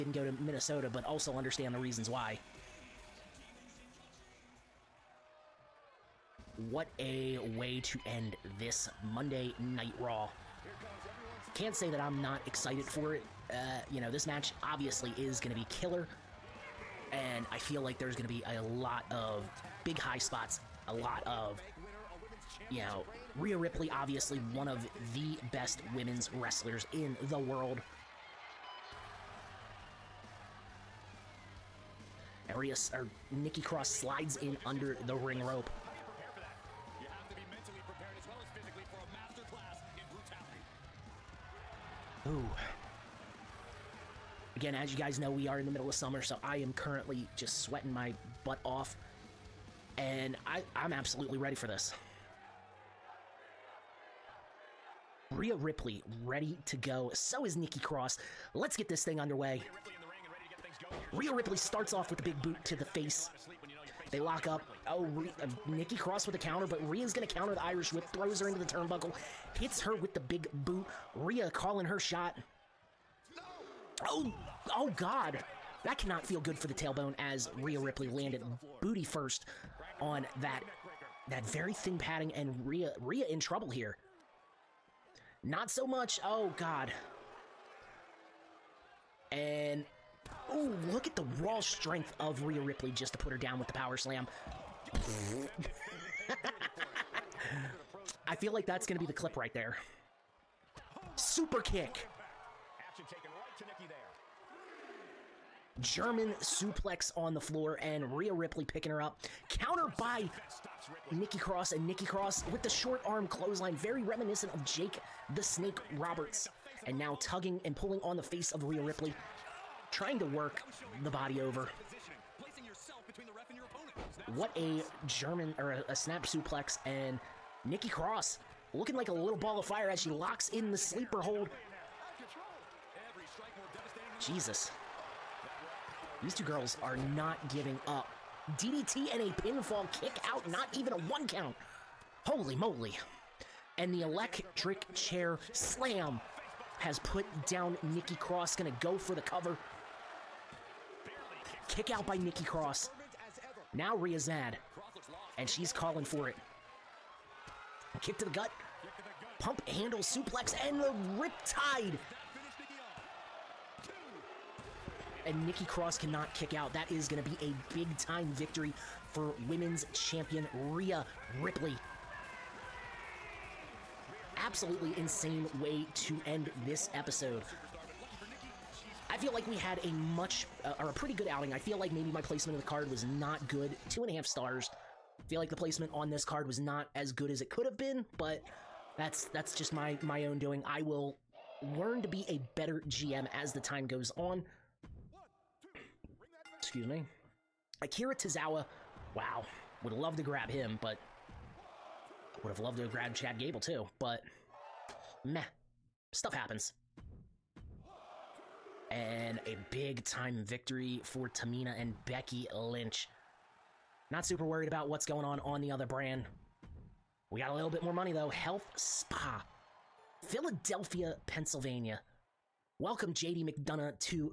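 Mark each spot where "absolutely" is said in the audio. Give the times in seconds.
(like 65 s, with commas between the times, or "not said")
50 s, 174 s.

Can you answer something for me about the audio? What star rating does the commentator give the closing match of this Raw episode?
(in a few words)
2.5 stars.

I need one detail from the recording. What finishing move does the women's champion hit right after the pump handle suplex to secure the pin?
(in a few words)
Riptide.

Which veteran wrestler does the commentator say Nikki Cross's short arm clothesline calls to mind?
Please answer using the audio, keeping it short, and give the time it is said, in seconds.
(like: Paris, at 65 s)
Jake the Snake Roberts, at 114 s.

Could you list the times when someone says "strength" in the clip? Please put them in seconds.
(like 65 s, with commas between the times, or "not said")
91 s.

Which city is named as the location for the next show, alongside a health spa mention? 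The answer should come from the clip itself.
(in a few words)
Philadelphia.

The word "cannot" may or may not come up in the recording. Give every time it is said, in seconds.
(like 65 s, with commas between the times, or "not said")
75 s, 165 s.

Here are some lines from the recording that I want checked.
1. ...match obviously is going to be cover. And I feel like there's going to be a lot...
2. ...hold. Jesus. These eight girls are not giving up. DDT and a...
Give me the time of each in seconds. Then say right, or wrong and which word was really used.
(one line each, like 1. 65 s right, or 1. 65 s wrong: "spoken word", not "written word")
1. 14 s wrong: "killer", not "cover"
2. 131 s wrong: "two", not "eight".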